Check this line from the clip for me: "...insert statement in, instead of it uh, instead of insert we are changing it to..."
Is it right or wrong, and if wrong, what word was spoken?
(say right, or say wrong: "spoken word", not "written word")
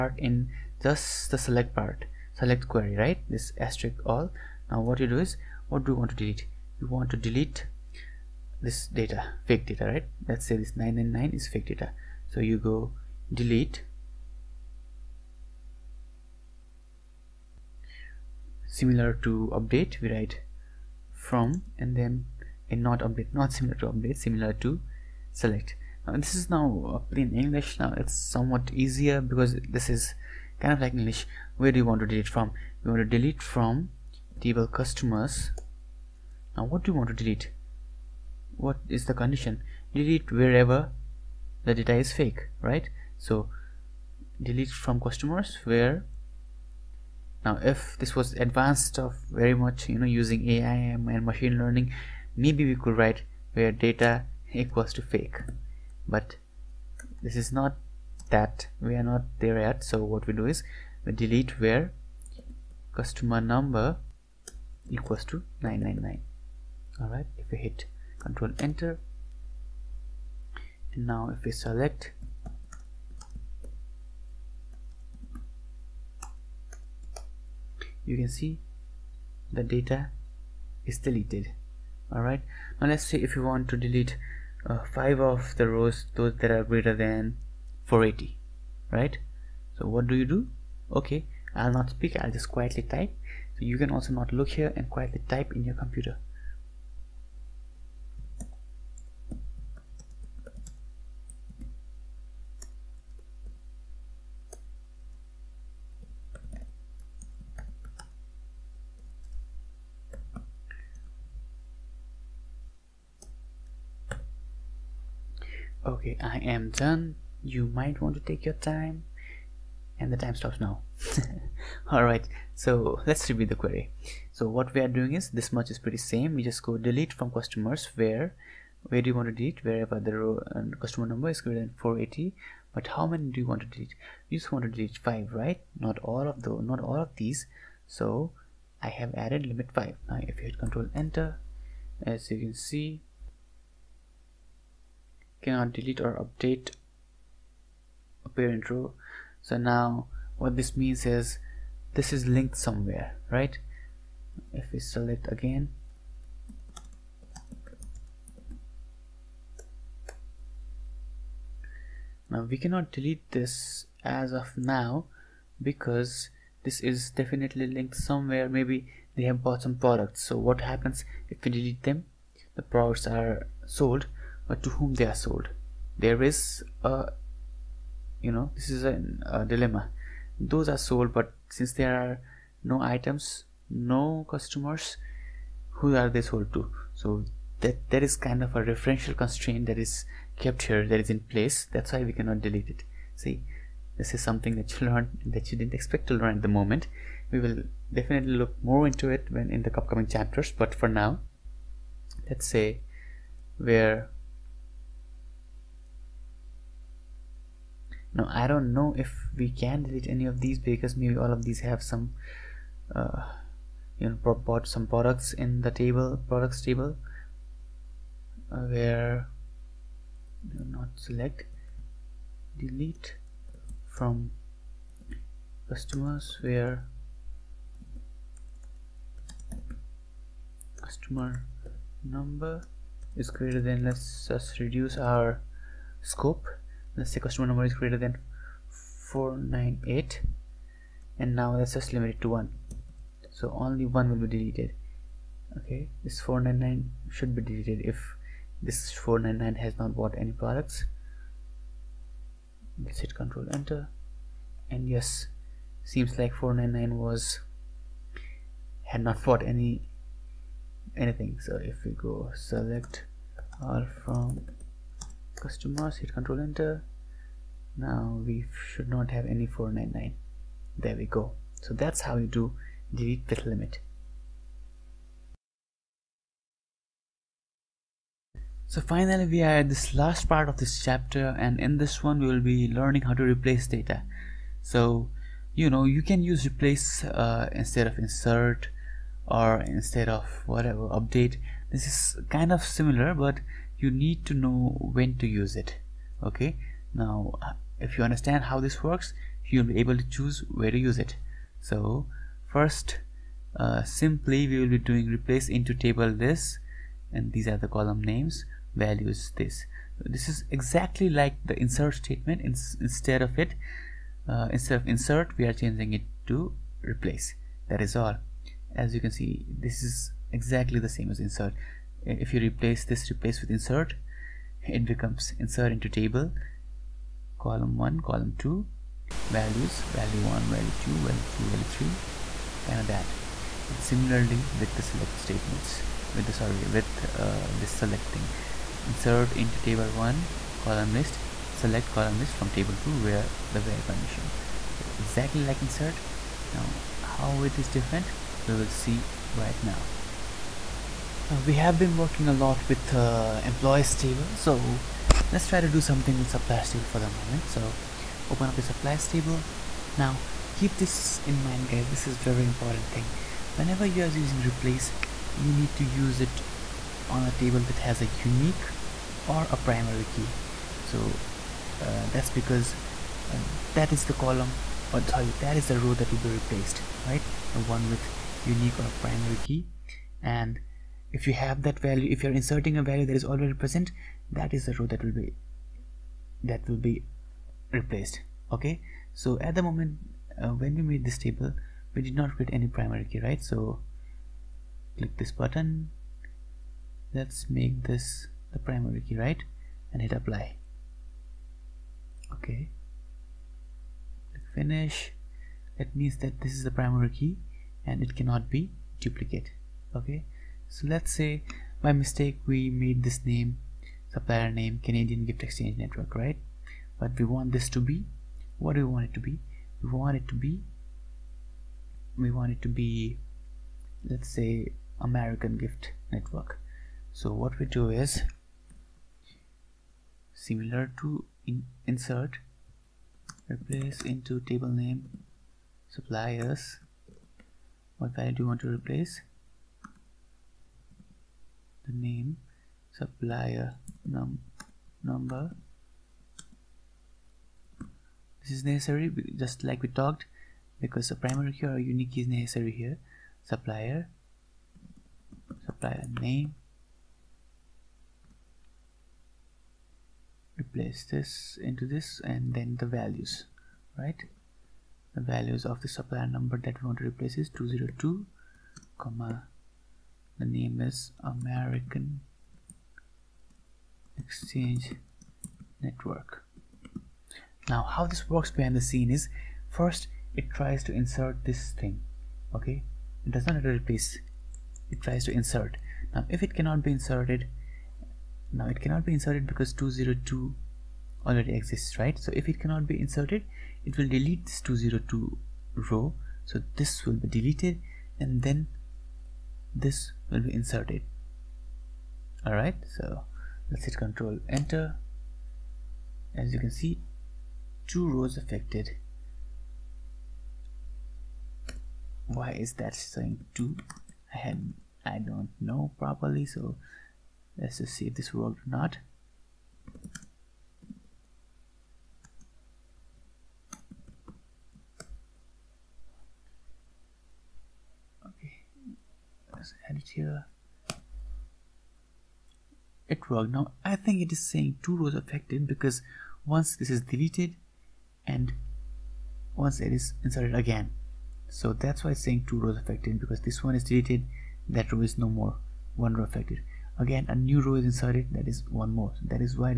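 right.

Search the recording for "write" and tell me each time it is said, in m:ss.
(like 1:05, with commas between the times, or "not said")
0:20, 0:52.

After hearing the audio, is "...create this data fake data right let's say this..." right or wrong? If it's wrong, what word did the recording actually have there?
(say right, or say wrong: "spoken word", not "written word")
wrong: "delete", not "create".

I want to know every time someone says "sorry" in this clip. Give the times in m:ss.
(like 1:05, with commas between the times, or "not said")
5:36, 6:15.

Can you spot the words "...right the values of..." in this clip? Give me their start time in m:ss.
7:43.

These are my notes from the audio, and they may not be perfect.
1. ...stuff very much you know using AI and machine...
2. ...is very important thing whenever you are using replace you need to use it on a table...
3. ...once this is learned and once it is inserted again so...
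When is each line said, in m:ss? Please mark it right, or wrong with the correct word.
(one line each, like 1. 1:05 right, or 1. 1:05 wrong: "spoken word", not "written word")
1. 0:48 right
2. 6:02 right
3. 8:56 wrong: "deleted", not "learned".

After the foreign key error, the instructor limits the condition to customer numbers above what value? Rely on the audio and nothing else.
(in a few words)
498.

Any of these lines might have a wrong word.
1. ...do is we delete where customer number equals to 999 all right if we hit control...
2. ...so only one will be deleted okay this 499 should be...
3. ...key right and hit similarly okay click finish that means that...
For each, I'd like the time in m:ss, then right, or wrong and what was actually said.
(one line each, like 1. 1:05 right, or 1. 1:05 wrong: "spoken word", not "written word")
1. 1:00 right
2. 4:03 right
3. 6:38 wrong: "apply", not "similarly".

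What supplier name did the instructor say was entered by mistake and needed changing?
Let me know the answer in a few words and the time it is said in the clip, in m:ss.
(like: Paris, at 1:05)
Canadian Gift Exchange Network, at 6:54.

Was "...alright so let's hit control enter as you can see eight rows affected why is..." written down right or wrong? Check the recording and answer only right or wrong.
wrong.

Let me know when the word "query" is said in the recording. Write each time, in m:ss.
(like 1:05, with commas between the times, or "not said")
0:02, 2:03.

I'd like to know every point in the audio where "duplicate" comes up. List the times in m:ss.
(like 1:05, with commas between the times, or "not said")
6:48.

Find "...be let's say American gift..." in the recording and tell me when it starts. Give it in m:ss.
7:02.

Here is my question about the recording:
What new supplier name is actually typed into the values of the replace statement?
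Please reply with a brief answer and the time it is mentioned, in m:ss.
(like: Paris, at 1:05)
American Exchange Network, at 7:51.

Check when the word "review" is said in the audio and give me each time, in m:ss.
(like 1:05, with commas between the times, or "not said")
2:03.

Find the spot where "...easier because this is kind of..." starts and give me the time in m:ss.
0:28.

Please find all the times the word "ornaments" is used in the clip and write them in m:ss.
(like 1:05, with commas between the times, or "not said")
not said.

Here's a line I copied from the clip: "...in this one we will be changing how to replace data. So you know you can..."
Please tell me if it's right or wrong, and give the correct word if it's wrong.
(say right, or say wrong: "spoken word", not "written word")
wrong: "learning", not "changing".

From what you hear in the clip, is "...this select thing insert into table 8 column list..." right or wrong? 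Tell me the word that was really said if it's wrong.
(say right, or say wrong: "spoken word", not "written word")
wrong: "1", not "8".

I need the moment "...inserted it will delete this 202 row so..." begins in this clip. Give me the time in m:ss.
8:12.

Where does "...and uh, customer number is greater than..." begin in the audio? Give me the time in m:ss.
2:10.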